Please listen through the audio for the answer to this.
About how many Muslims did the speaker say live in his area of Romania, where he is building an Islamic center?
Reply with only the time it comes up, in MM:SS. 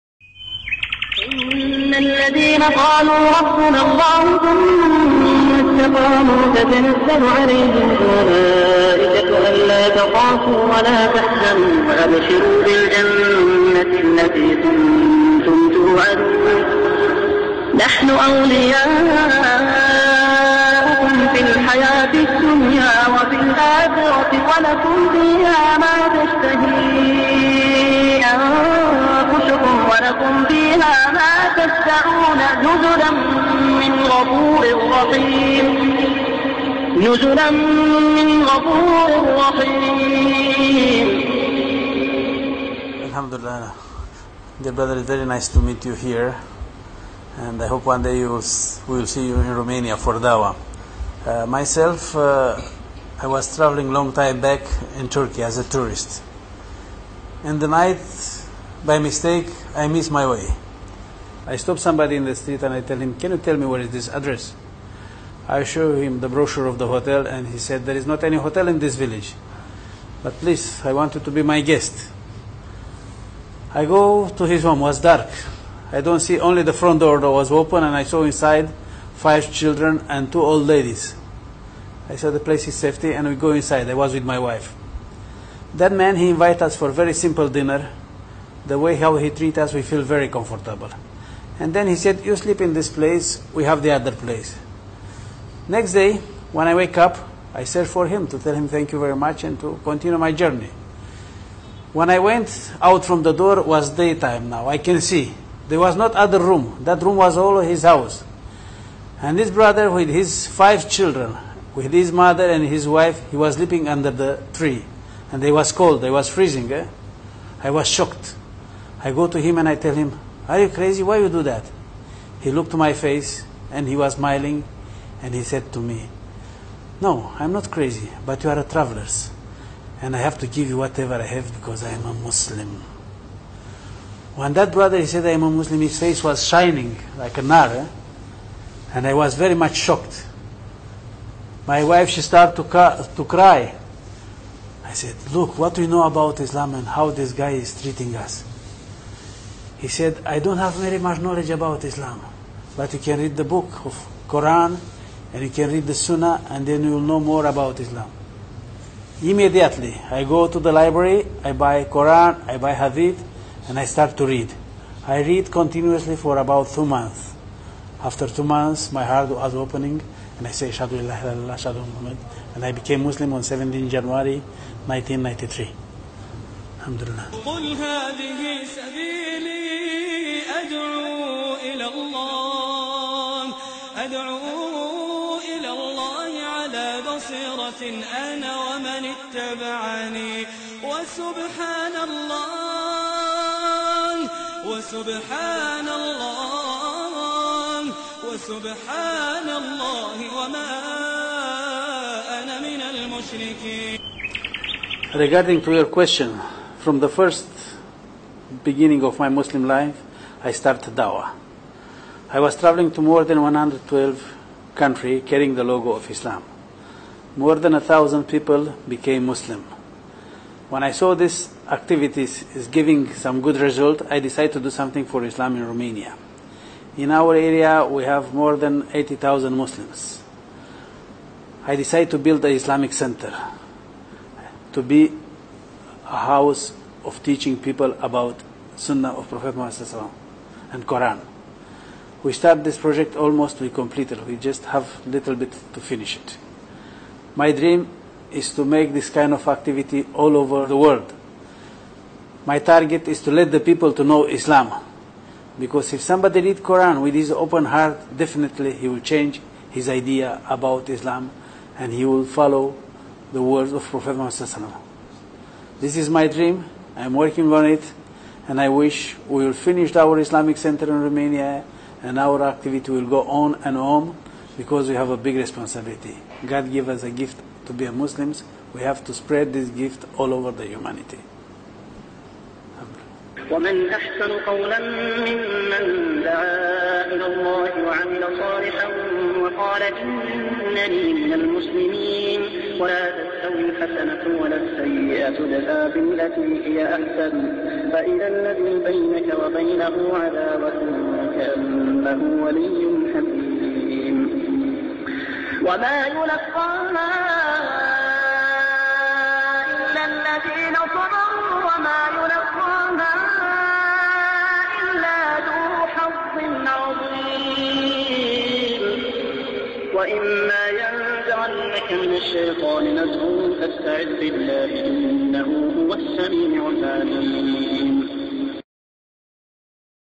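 03:48.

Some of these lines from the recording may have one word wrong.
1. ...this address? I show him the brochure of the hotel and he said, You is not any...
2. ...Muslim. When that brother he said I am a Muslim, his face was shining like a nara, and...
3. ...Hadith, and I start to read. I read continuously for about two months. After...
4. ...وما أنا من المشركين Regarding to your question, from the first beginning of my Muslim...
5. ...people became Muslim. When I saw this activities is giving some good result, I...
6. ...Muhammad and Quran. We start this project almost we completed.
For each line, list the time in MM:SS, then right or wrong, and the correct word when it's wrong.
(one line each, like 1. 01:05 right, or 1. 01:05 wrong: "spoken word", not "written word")
1. 01:03 wrong: "There", not "You"
2. 02:12 right
3. 02:42 right
4. 03:20 right
5. 03:38 right
6. 03:59 right.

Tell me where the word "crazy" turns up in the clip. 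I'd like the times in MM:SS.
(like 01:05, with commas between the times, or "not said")
02:00, 02:07.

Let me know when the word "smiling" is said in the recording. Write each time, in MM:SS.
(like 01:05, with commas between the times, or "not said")
02:04.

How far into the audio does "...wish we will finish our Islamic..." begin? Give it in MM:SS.
04:28.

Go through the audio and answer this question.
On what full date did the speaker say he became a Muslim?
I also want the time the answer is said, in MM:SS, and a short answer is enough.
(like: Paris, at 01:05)
17 January 1993, at 02:53.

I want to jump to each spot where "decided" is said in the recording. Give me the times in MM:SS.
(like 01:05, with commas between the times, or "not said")
03:44, 03:51.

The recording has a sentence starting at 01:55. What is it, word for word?
And they was cold, they was freezing.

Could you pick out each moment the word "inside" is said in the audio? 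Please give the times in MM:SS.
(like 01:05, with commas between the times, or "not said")
01:18, 01:23.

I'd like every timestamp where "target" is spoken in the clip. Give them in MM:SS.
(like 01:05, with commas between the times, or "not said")
04:12.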